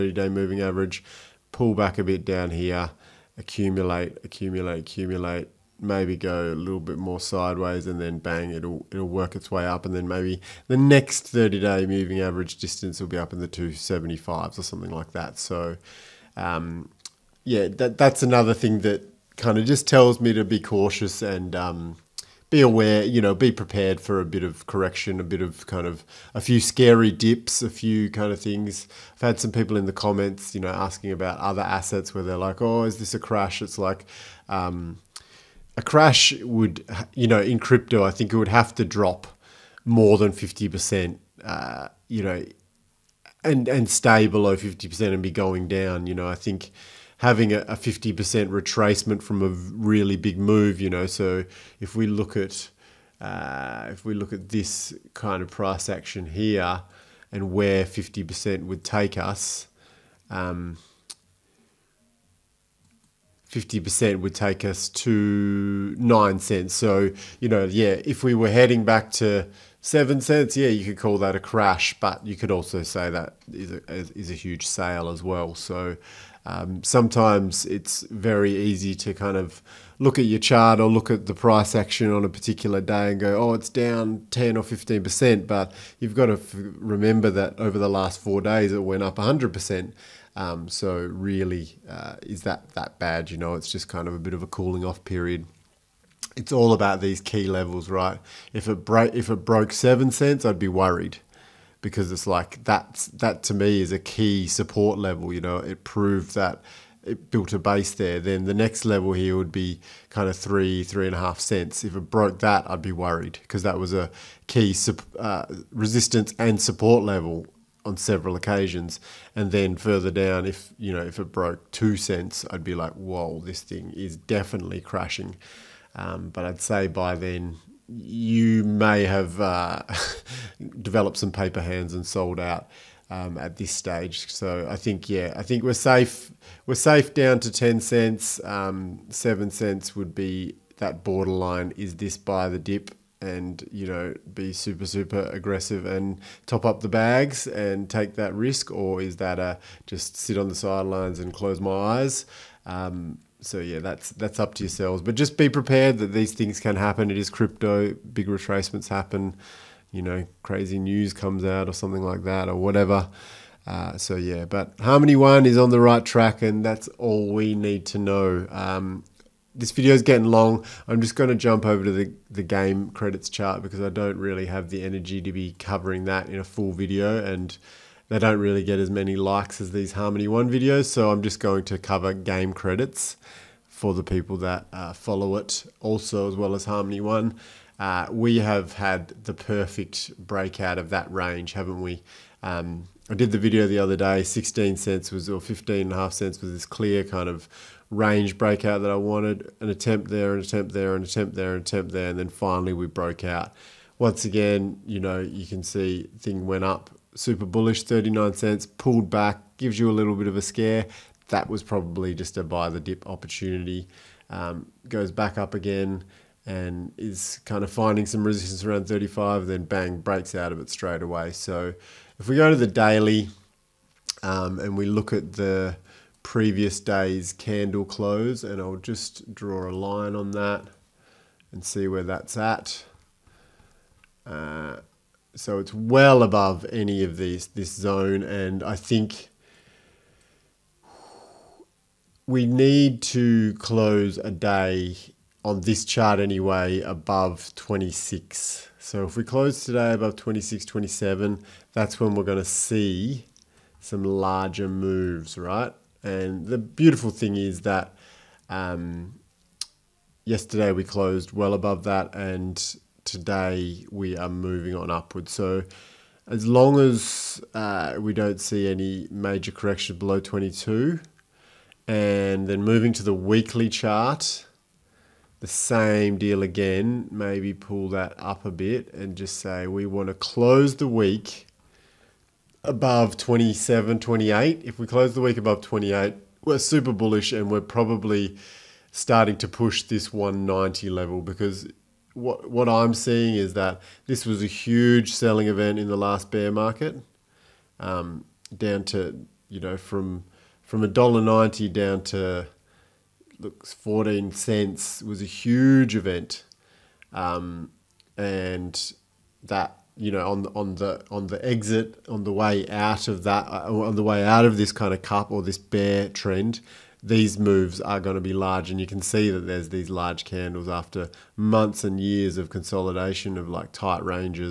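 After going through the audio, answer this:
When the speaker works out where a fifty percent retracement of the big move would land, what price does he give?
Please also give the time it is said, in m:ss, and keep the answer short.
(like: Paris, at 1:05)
9 cents, at 1:05.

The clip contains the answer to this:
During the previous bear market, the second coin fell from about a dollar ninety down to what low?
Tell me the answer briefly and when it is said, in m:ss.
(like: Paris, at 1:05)
14 cents, at 5:03.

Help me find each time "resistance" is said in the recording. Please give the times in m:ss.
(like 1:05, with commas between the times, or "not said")
1:55, 3:38.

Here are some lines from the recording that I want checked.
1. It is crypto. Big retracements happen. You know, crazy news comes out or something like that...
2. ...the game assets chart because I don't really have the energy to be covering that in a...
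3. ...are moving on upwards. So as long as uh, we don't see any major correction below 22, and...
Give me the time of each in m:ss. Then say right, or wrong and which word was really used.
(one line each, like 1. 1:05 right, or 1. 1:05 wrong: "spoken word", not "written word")
1. 2:37 right
2. 2:52 wrong: "credits", not "assets"
3. 4:24 right.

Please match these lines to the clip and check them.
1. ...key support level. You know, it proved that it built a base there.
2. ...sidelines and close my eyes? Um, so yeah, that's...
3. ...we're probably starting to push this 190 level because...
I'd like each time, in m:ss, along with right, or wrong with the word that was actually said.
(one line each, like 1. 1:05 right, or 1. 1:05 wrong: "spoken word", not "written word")
1. 1:43 right
2. 2:30 right
3. 4:47 right.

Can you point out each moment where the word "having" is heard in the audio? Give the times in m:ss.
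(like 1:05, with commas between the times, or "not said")
0:47.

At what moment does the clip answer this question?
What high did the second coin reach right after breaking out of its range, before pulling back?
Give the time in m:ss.
3:27.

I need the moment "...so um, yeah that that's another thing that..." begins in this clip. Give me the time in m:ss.
0:15.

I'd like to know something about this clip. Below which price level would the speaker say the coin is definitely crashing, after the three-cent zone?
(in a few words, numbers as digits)
2 cents.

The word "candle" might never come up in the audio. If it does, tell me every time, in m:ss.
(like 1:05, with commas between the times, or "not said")
3:47, 5:20.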